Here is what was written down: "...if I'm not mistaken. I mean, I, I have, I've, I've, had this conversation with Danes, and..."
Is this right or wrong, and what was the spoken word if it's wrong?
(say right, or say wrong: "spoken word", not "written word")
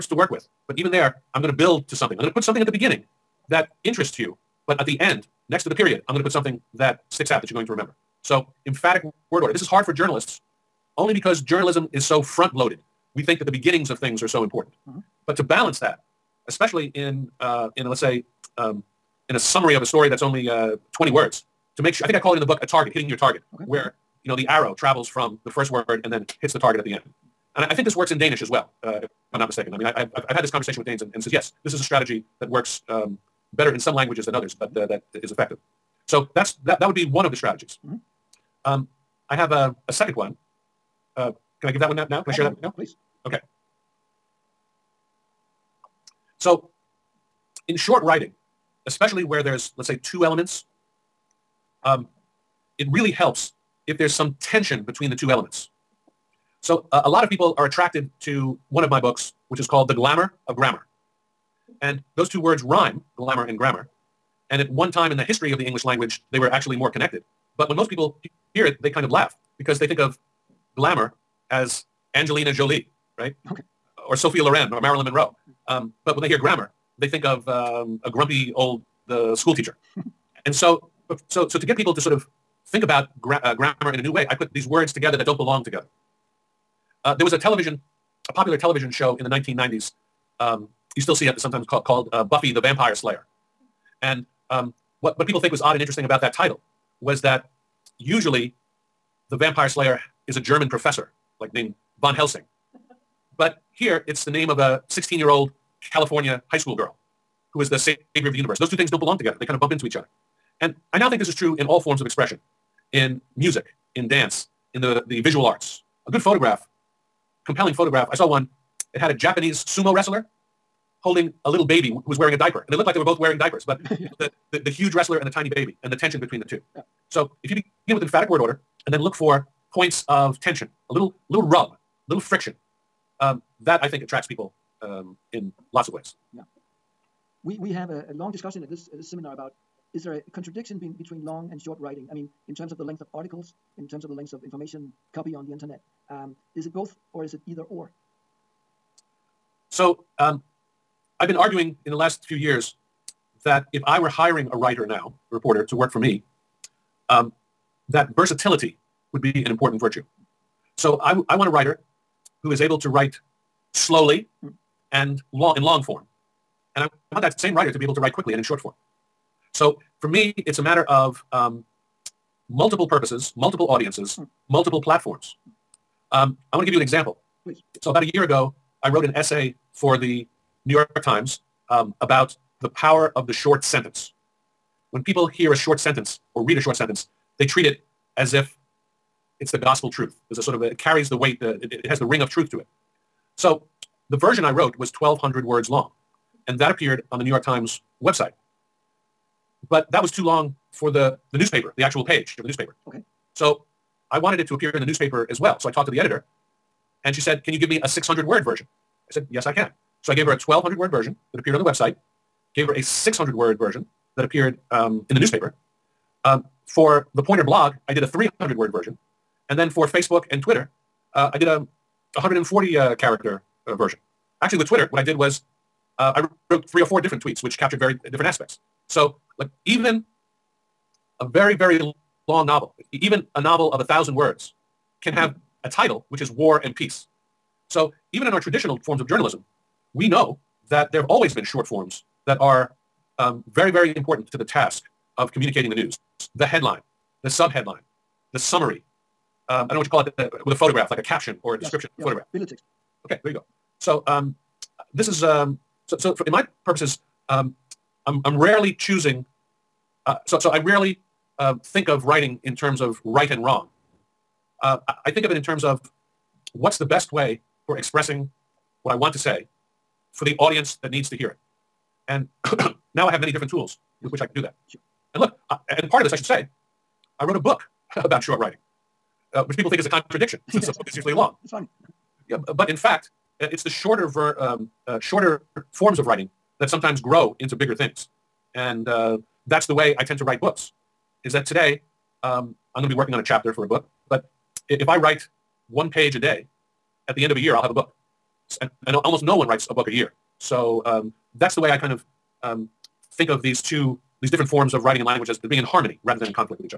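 right.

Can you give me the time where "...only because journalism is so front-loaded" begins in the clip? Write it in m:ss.
0:10.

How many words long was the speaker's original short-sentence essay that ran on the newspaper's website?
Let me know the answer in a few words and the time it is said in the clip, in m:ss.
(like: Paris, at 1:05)
1,200, at 3:14.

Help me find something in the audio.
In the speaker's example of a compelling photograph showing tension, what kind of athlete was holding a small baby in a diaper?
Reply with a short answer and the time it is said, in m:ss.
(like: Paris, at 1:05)
Sumo wrestler, at 1:59.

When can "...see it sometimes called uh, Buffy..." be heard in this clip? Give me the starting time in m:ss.
1:31.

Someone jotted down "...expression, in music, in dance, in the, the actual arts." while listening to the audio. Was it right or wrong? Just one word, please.
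wrong.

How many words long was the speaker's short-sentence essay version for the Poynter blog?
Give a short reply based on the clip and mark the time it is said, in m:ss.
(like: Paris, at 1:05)
300, at 3:38.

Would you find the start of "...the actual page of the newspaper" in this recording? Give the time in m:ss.
3:21.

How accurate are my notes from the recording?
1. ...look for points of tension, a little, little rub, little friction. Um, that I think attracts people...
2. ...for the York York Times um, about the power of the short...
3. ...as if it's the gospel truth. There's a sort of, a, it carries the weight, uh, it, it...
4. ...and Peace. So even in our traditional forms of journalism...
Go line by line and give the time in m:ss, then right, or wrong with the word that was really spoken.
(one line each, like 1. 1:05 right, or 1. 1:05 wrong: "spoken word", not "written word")
1. 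2:08 right
2. 2:59 wrong: "New", not "York"
3. 3:08 right
4. 3:56 right.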